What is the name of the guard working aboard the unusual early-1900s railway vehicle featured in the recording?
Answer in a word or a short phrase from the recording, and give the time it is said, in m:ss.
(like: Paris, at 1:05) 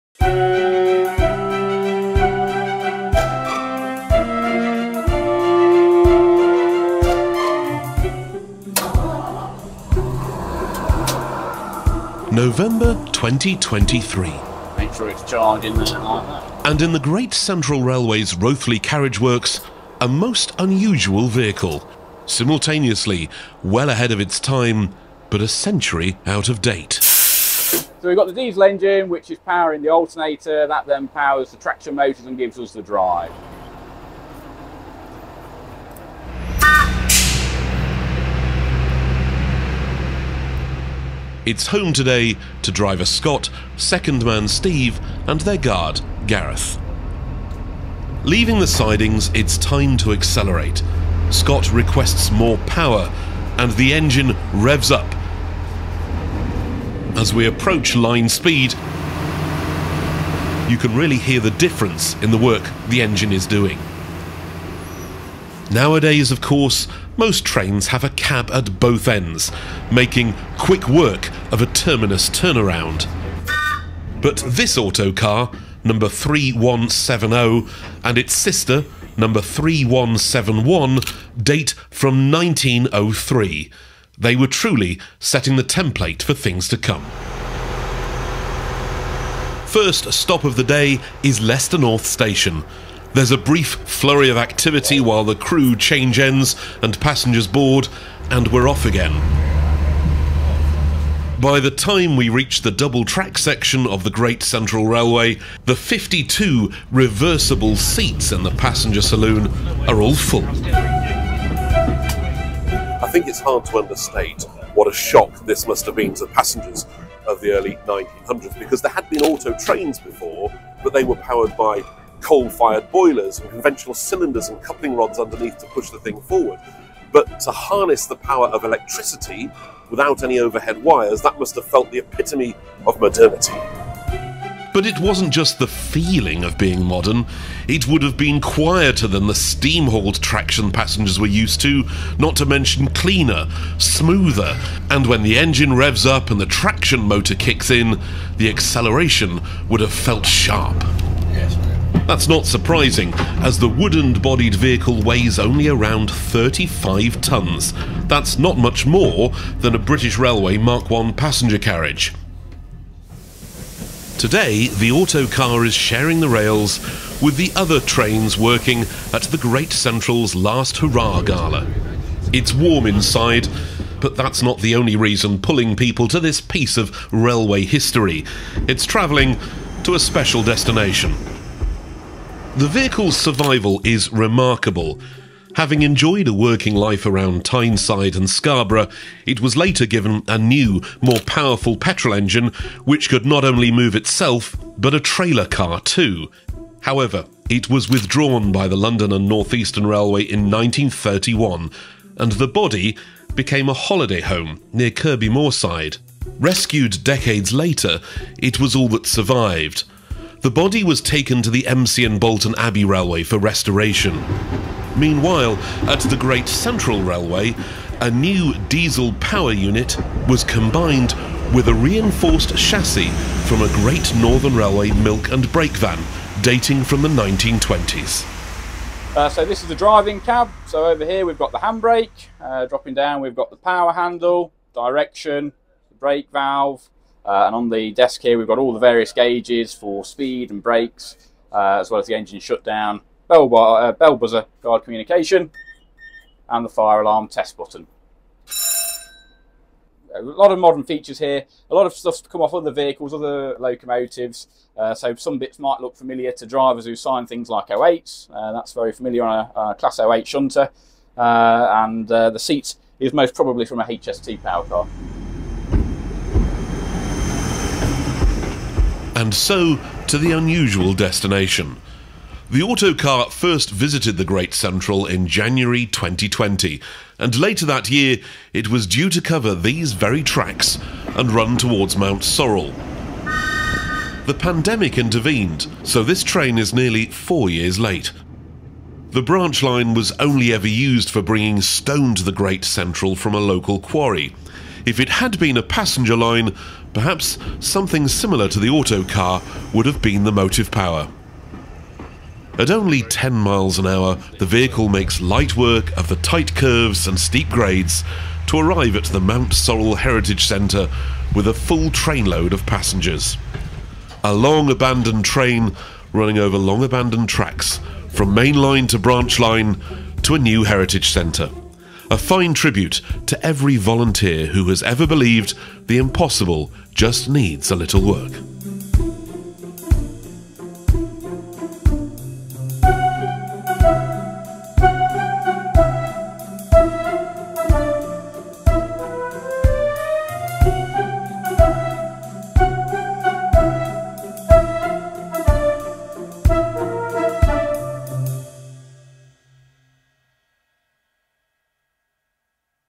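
Gareth, at 0:46.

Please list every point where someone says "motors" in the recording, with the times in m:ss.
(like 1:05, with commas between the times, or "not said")
0:31, 2:27.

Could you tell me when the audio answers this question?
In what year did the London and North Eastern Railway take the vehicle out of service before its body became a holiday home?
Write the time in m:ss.
3:20.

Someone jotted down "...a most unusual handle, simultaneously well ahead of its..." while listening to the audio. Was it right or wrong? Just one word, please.
wrong.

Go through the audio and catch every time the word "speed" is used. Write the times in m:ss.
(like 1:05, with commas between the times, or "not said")
0:58, 4:00.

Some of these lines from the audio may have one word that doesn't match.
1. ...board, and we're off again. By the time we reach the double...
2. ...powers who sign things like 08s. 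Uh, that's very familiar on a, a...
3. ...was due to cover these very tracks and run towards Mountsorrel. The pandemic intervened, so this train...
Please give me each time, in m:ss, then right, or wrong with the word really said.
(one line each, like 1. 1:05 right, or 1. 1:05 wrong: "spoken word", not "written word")
1. 1:37 right
2. 4:16 wrong: "drivers", not "powers"
3. 4:38 right.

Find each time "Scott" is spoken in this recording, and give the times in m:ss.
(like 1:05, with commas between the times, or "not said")
0:43, 0:51.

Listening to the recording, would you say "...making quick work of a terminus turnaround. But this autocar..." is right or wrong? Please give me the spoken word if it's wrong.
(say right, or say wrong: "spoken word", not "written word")
right.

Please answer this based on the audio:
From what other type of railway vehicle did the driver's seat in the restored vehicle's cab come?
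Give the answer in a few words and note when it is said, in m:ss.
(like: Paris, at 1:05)
HST power car, at 4:23.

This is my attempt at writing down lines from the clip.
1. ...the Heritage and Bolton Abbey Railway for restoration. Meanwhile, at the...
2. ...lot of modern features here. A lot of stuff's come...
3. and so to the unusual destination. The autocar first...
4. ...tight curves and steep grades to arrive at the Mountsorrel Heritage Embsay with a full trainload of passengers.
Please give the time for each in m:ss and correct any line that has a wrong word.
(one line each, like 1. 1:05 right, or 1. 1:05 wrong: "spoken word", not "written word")
1. 3:31 wrong: "Embsay", not "Heritage"
2. 4:10 right
3. 4:29 right
4. 5:06 wrong: "Centre", not "Embsay".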